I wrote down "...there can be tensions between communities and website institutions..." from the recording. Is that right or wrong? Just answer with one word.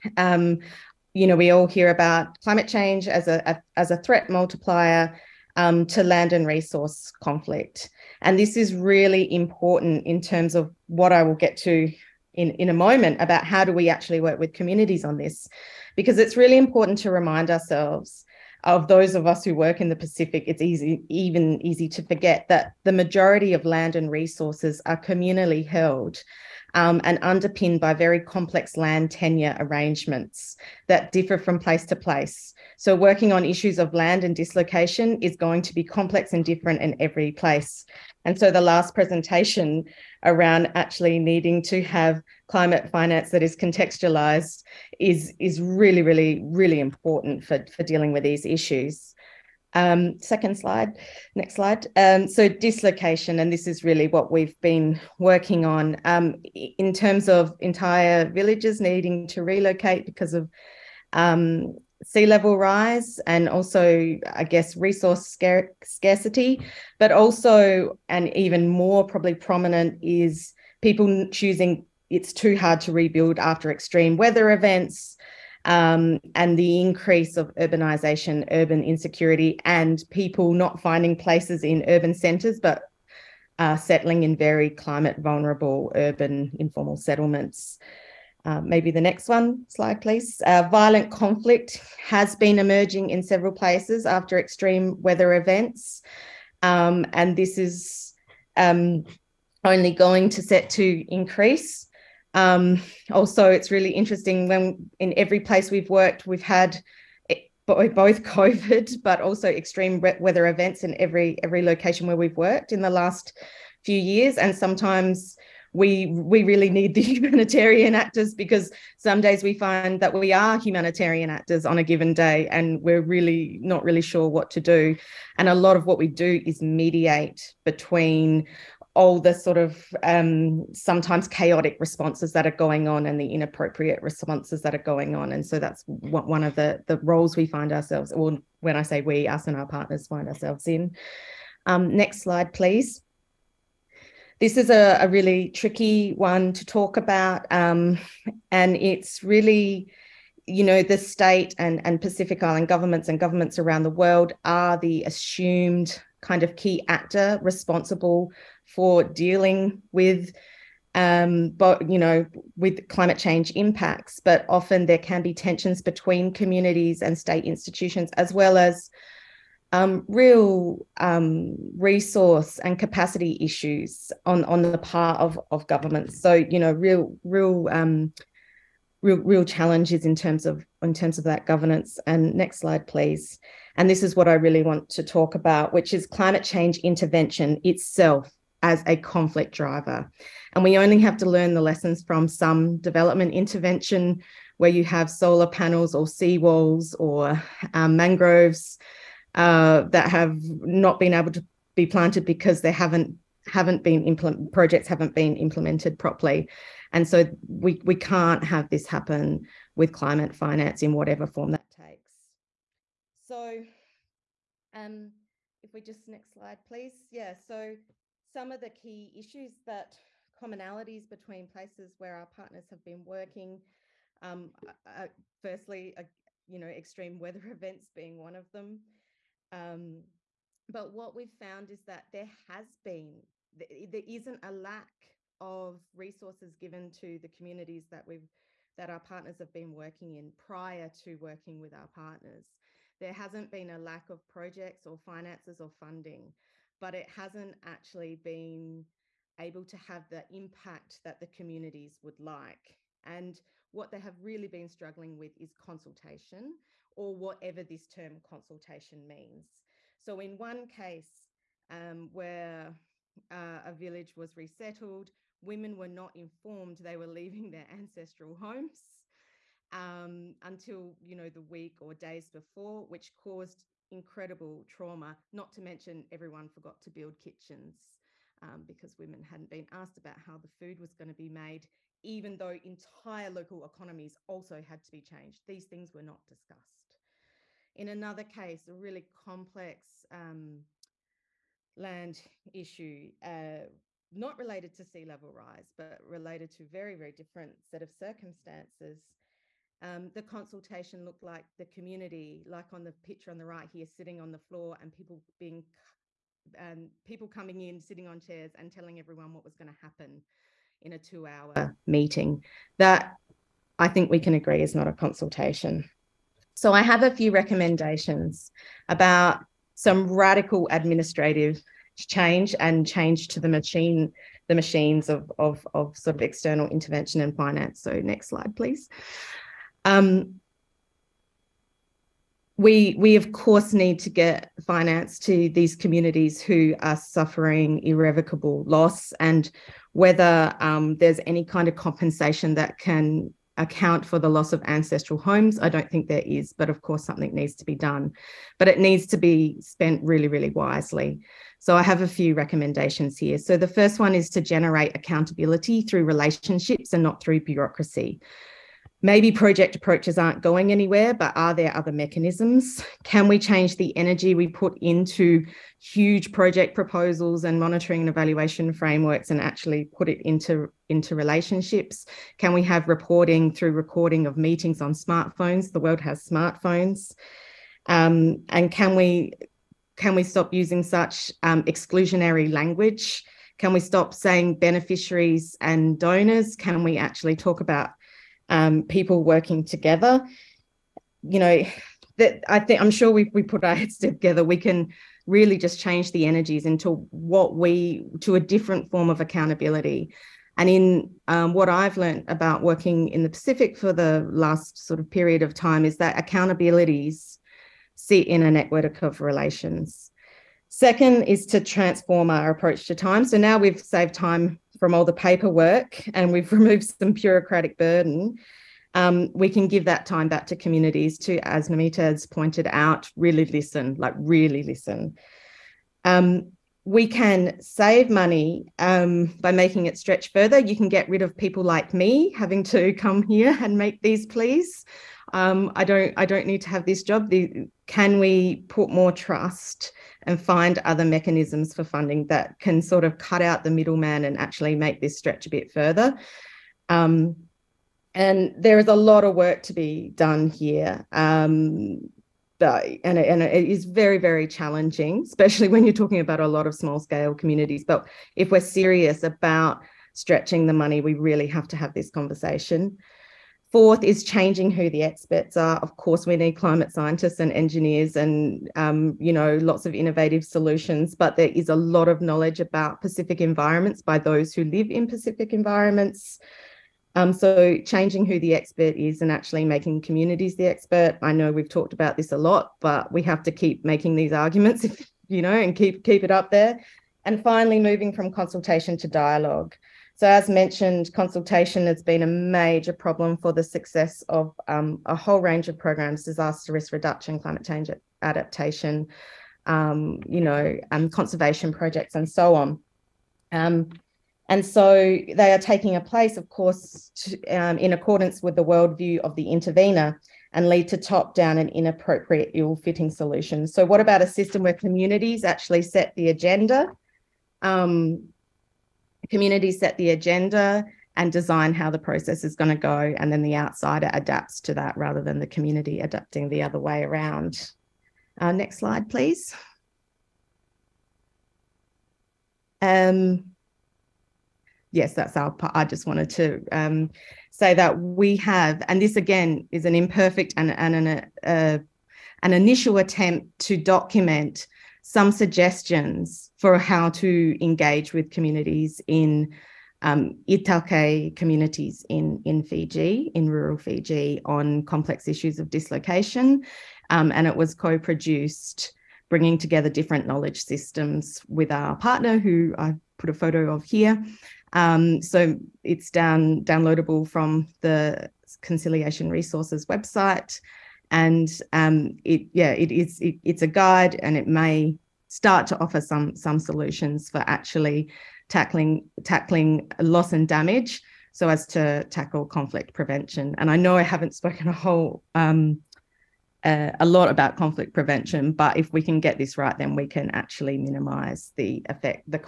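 wrong.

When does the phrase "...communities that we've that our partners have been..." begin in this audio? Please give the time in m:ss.
3:57.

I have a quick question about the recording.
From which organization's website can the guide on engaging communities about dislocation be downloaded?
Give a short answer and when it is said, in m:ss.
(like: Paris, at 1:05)
Conciliation Resources, at 9:28.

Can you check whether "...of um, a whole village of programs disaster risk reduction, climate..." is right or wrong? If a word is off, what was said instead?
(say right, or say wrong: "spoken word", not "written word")
wrong: "range", not "village".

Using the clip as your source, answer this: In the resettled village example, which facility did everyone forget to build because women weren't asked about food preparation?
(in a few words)
kitchens.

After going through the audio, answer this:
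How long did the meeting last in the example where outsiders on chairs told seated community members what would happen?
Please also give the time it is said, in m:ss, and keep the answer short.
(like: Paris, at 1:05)
2 hours, at 5:10.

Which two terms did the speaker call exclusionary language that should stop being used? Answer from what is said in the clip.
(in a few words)
beneficiaries and donors.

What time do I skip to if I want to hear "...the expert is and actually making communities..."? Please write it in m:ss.
7:58.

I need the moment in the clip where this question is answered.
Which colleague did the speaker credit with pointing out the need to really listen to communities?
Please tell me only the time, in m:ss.
7:01.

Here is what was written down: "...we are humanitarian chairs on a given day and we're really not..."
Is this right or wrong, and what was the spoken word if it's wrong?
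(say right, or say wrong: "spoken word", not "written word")
wrong: "actors", not "chairs".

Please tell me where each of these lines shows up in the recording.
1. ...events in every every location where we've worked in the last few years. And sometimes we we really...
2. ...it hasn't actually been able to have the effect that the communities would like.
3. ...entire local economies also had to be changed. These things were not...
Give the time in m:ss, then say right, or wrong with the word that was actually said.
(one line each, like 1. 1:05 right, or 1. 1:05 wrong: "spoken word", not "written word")
1. 1:50 right
2. 4:06 wrong: "impact", not "effect"
3. 4:42 right.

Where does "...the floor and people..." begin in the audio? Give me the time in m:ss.
5:04.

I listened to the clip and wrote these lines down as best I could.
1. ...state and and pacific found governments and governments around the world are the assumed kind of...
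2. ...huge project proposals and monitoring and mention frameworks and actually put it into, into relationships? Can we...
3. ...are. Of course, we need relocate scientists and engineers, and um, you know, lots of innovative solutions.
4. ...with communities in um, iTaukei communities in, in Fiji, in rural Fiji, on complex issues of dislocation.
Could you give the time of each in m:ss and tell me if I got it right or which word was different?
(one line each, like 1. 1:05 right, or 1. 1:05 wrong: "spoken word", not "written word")
1. 2:30 wrong: "island", not "found"
2. 6:05 wrong: "evaluation", not "mention"
3. 7:45 wrong: "climate", not "relocate"
4. 9:08 right.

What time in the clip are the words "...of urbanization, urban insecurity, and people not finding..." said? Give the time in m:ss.
1:17.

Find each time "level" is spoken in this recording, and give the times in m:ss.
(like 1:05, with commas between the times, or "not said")
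1:02, 4:55.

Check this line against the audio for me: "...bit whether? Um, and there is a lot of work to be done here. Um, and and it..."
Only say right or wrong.
wrong.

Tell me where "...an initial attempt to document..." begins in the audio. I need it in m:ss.
9:02.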